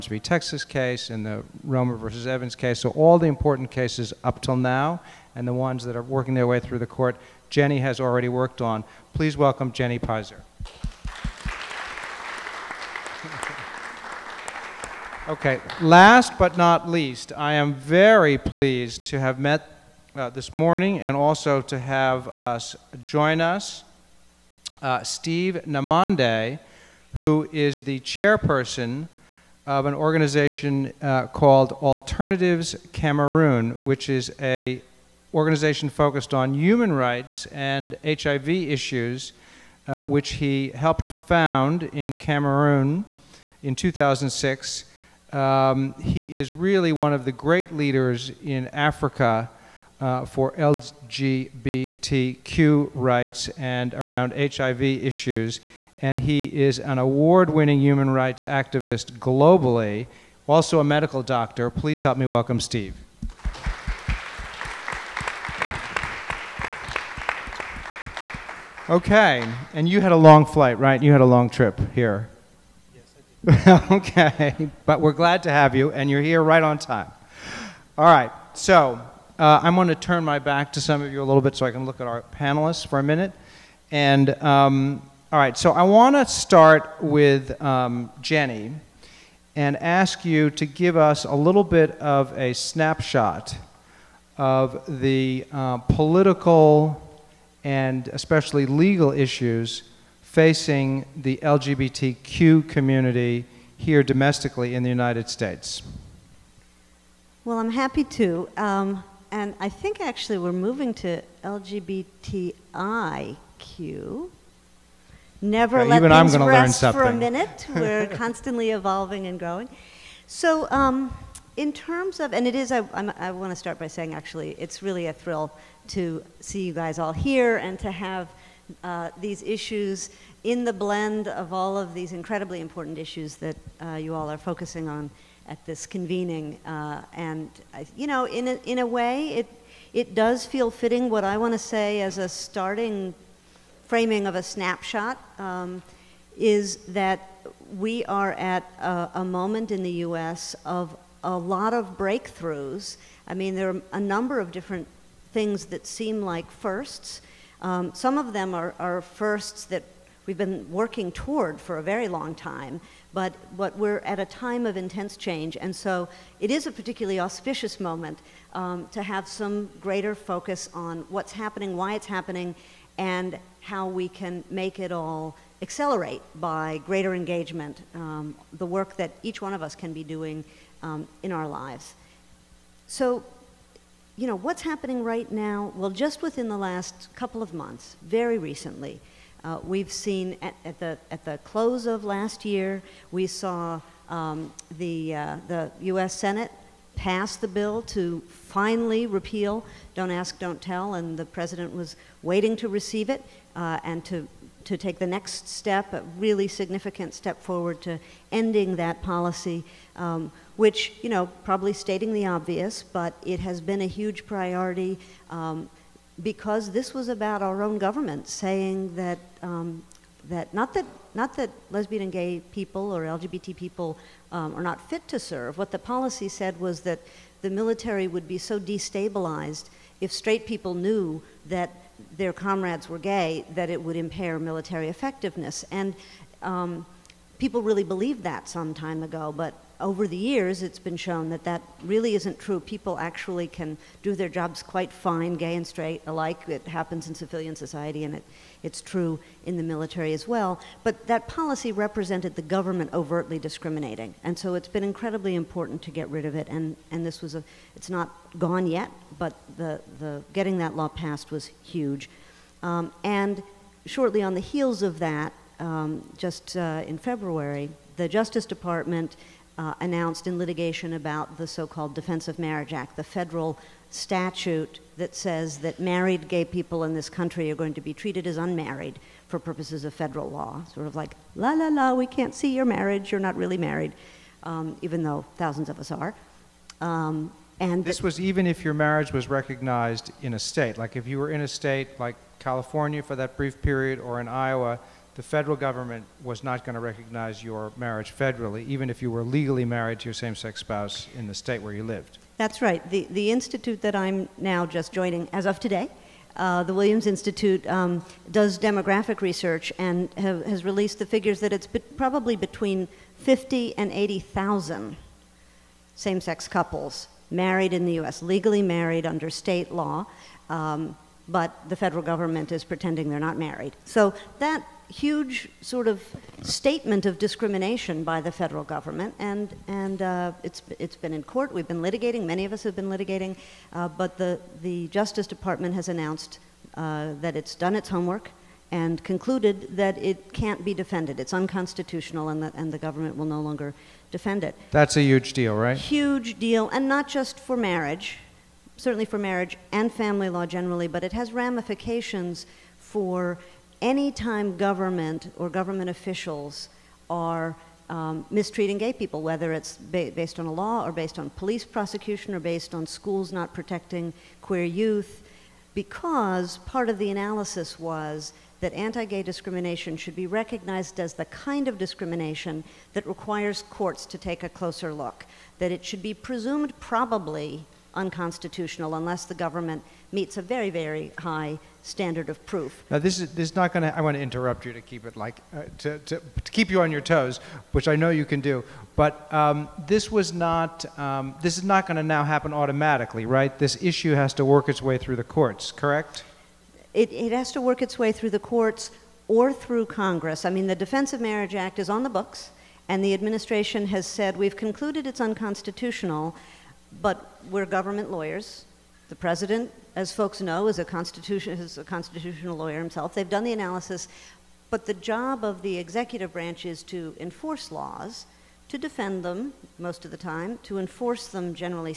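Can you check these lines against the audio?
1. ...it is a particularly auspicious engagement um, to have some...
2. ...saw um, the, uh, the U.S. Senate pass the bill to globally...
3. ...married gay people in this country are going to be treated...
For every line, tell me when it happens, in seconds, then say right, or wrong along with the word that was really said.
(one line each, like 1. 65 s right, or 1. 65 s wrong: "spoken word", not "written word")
1. 166 s wrong: "moment", not "engagement"
2. 193 s wrong: "finally", not "globally"
3. 275 s right.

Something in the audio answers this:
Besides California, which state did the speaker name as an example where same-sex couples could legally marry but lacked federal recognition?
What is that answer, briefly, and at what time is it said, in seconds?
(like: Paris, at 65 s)
Iowa, at 294 s.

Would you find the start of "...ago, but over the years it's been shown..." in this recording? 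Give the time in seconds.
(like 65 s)
239 s.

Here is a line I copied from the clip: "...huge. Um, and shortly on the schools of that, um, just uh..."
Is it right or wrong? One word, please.
wrong.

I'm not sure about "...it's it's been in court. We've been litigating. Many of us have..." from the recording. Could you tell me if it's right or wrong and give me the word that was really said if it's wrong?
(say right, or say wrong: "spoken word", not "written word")
right.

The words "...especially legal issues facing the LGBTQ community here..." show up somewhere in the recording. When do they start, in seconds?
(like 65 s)
98 s.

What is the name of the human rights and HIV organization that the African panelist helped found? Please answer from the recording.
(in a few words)
Alternatives Cameroon.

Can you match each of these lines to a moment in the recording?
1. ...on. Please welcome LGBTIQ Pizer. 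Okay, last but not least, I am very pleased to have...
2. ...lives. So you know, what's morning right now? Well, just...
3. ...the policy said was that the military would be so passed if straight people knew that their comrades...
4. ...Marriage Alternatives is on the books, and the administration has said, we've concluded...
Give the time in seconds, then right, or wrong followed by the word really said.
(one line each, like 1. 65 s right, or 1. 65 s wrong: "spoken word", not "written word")
1. 8 s wrong: "Jenny", not "LGBTIQ"
2. 181 s wrong: "happening", not "morning"
3. 225 s wrong: "destabilized", not "passed"
4. 401 s wrong: "Act", not "Alternatives".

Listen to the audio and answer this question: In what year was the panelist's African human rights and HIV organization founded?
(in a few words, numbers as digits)
2006.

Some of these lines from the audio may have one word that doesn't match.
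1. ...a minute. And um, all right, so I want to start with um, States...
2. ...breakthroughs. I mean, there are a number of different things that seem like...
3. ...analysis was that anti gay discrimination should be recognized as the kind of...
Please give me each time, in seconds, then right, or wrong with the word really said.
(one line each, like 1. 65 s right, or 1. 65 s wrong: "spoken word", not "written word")
1. 82 s wrong: "Jenny", not "States"
2. 151 s right
3. 367 s right.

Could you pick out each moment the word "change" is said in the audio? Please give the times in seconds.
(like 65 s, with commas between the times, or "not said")
165 s.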